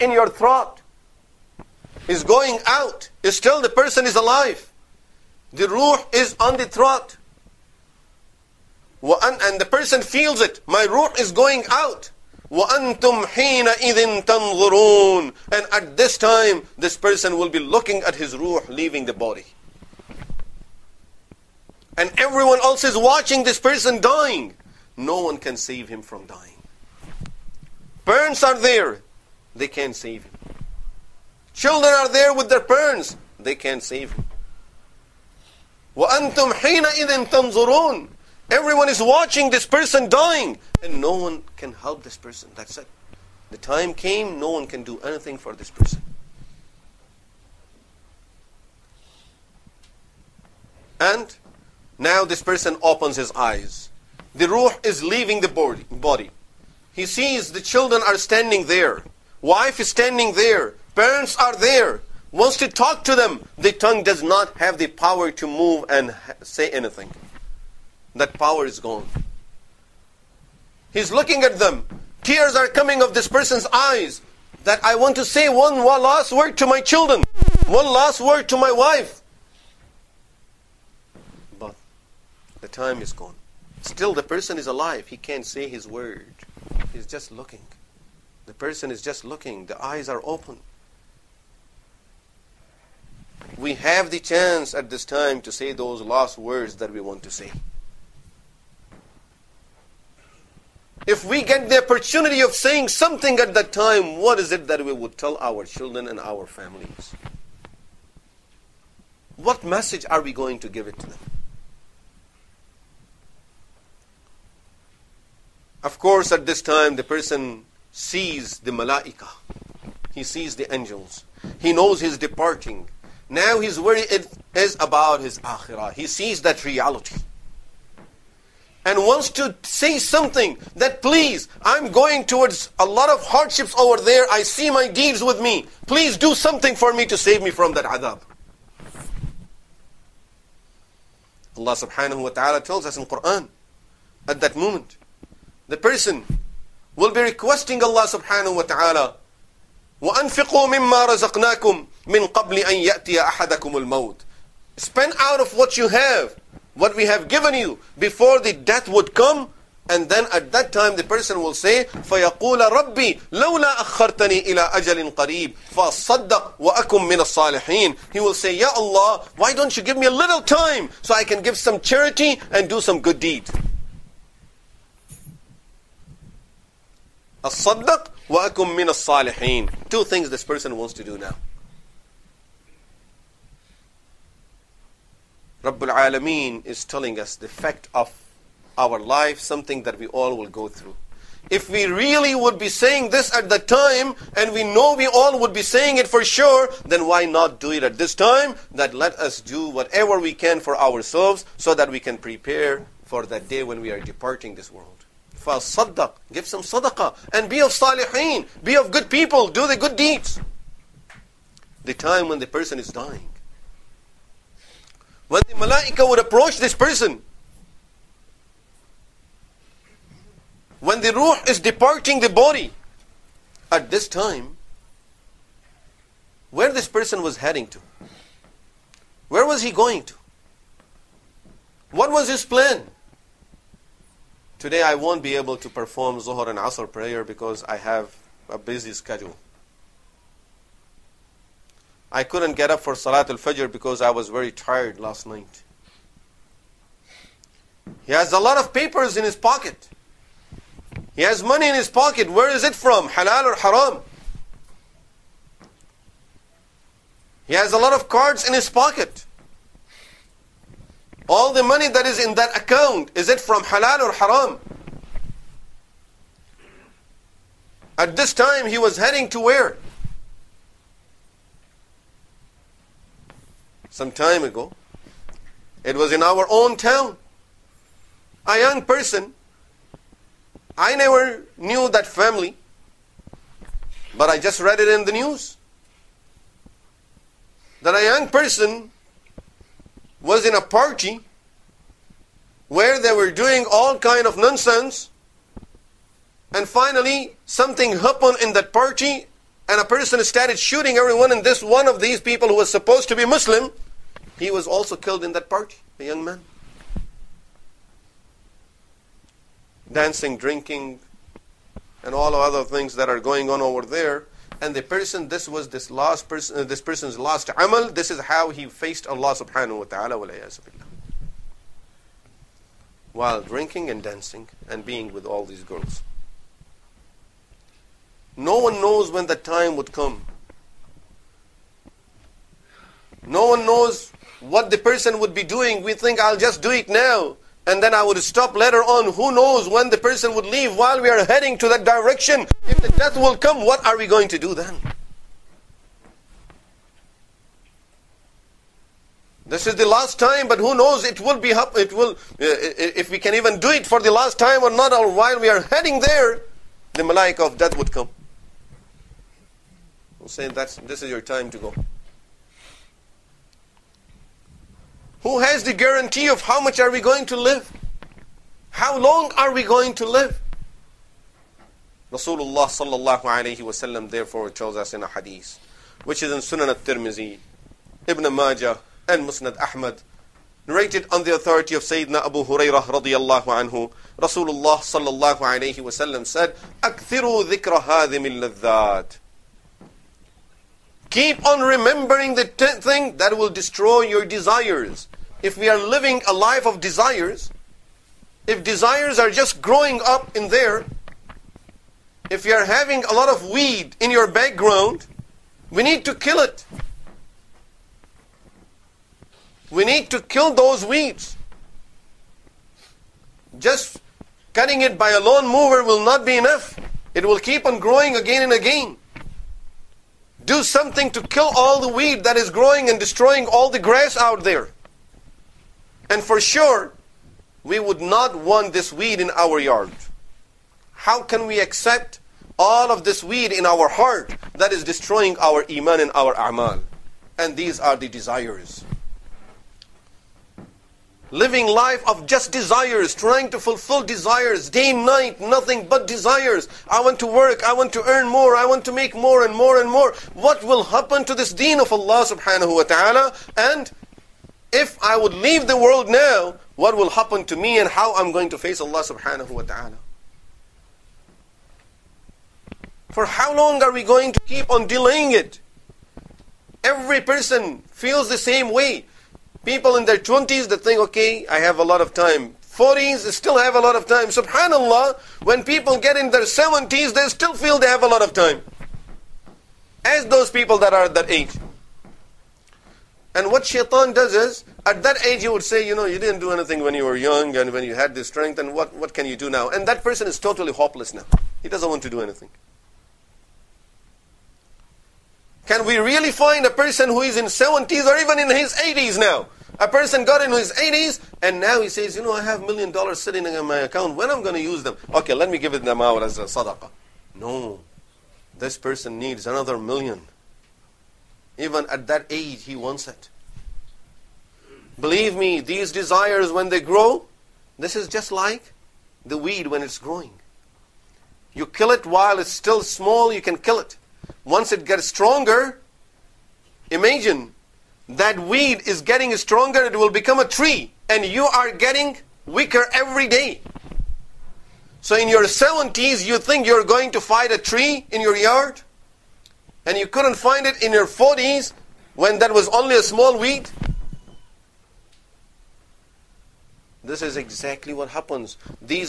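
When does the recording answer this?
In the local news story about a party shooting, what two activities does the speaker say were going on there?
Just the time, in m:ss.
5:09.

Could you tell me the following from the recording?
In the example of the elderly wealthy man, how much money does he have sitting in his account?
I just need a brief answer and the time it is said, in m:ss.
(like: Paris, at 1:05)
1 million dollars, at 8:22.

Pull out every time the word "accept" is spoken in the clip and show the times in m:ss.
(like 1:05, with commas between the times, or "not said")
7:11.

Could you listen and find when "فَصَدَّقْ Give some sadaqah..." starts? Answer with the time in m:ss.
3:25.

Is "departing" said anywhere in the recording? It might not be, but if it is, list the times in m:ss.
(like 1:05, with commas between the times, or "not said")
2:02, 3:24, 3:41.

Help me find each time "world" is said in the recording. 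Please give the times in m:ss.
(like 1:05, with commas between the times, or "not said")
3:24, 7:35.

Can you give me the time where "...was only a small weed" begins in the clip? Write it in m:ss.
9:02.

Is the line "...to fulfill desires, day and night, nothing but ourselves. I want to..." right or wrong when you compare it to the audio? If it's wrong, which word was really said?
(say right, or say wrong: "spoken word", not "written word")
wrong: "desires", not "ourselves".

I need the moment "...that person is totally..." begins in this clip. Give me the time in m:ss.
8:09.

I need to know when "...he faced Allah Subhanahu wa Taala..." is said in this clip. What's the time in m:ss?
5:18.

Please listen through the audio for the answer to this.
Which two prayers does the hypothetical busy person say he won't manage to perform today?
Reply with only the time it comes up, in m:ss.
3:56.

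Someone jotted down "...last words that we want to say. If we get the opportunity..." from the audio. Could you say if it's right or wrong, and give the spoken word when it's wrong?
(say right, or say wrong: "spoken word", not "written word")
right.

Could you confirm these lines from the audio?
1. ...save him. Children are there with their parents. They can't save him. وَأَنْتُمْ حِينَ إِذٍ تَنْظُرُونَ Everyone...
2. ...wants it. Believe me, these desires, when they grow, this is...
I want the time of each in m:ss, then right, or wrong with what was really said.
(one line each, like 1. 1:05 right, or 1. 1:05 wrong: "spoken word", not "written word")
1. 0:29 right
2. 8:32 right.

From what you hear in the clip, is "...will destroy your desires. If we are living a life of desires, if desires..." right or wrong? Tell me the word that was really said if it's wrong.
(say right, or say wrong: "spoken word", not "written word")
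right.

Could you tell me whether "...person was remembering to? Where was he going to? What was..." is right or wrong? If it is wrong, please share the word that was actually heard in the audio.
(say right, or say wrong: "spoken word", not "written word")
wrong: "heading", not "remembering".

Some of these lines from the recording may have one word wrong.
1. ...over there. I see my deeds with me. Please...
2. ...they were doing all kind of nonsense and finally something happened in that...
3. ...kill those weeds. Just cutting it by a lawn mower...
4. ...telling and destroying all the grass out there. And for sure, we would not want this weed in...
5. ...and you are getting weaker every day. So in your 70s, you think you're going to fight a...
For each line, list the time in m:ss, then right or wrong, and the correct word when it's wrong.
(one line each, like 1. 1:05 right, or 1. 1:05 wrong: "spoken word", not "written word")
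1. 2:13 right
2. 4:52 right
3. 6:50 right
4. 7:02 wrong: "growing", not "telling"
5. 8:51 right.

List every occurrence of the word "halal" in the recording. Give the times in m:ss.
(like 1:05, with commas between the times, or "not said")
4:13, 4:23.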